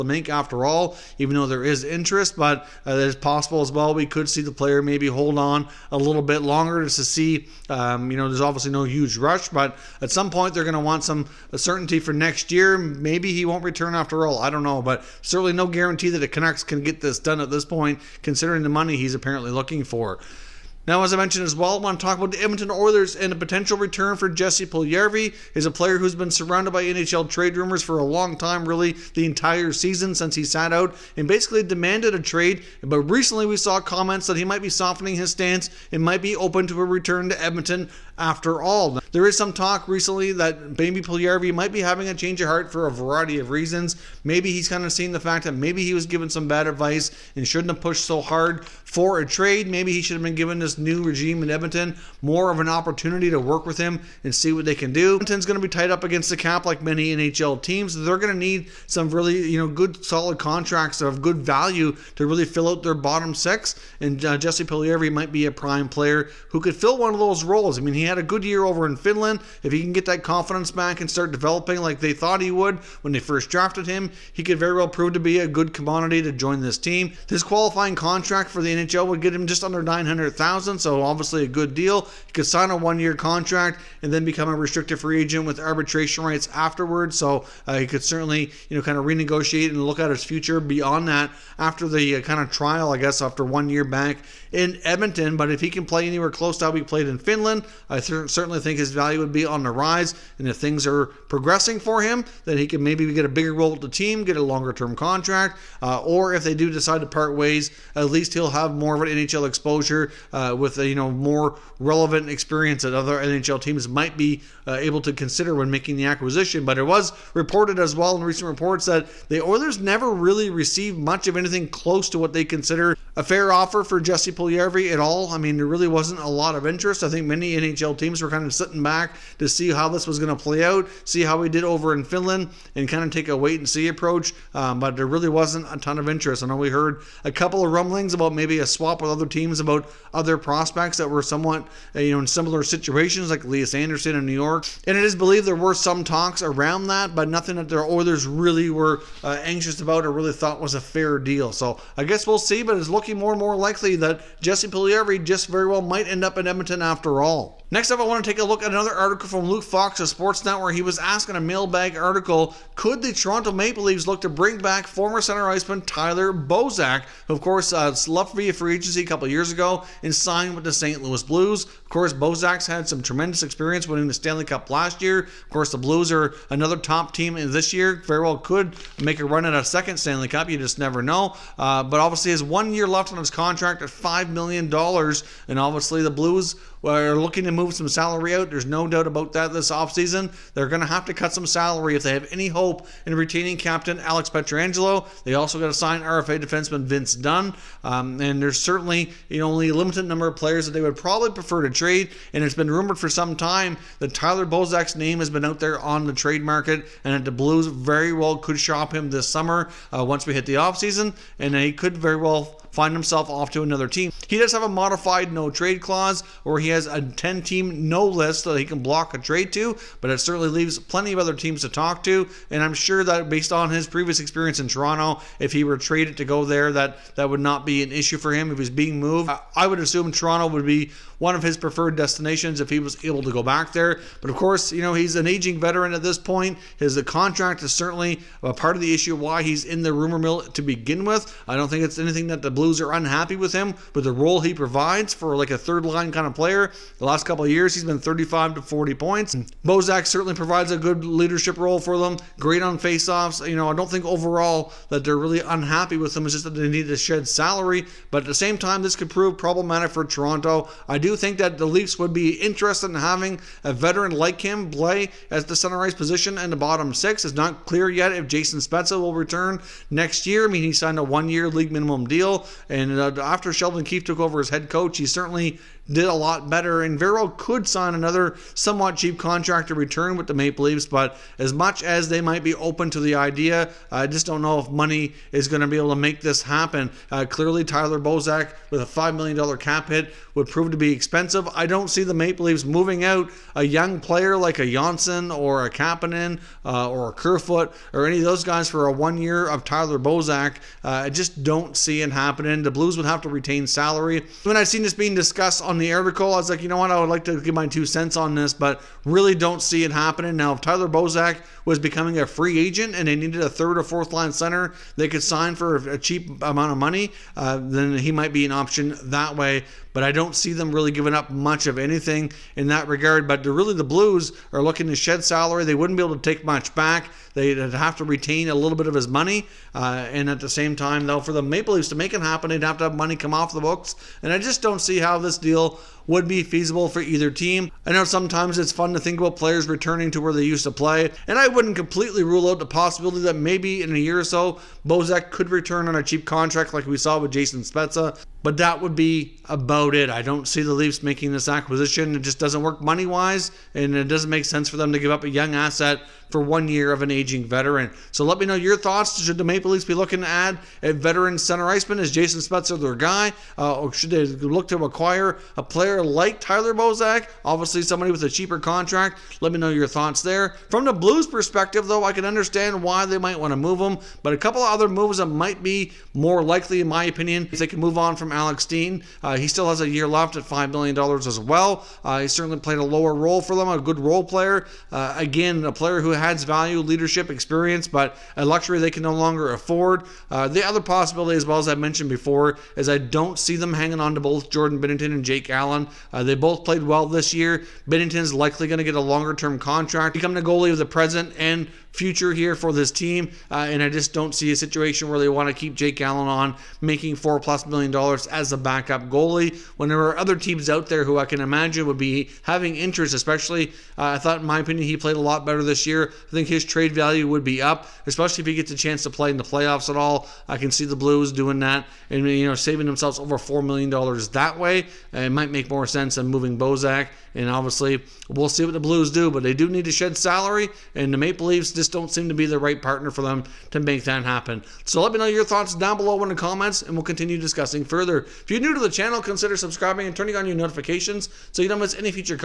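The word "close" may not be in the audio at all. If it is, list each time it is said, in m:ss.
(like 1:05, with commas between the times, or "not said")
1:36, 2:01.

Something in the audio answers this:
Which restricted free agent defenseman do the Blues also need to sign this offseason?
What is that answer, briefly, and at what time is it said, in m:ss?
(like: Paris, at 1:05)
Vince Dunn, at 3:16.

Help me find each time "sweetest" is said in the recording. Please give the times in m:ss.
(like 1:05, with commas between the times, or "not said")
not said.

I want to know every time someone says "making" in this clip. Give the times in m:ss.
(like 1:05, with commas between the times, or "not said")
1:55, 5:51, 6:46.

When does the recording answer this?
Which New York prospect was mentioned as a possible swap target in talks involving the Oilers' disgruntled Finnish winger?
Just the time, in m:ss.
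2:23.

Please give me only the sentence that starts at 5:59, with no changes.
Should the Maple Leafs be looking to add a veteran center iceman?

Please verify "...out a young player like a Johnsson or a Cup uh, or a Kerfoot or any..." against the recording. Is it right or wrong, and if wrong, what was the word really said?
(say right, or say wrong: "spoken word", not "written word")
wrong: "Kapanen", not "Cup".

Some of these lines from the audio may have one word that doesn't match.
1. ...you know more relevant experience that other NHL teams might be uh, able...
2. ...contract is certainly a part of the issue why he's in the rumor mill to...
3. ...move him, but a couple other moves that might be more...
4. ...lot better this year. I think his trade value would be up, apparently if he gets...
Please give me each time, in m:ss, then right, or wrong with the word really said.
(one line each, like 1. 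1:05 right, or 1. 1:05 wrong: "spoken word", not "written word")
1. 1:50 right
2. 3:57 right
3. 6:13 right
4. 6:55 wrong: "especially", not "apparently".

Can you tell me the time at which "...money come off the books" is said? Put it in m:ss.
5:32.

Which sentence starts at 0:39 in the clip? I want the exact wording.
There is some talk recently that Baby Puljujarvi might be having a change of heart for a variety of reasons.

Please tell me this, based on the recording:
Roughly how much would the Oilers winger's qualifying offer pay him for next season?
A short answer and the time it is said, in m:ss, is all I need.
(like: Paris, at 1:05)
just under 900,000, at 1:19.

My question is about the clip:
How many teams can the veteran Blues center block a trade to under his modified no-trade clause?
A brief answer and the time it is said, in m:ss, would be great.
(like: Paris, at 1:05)
10, at 3:37.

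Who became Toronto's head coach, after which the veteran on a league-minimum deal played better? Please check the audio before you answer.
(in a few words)
Sheldon Keefe.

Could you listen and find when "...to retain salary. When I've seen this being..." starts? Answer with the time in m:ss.
5:03.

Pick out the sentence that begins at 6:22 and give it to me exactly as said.
Uh, he certainly played a lower role for them, a good role player.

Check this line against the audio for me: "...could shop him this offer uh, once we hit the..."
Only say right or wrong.
wrong.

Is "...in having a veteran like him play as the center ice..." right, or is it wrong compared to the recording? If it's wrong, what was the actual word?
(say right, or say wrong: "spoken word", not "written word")
right.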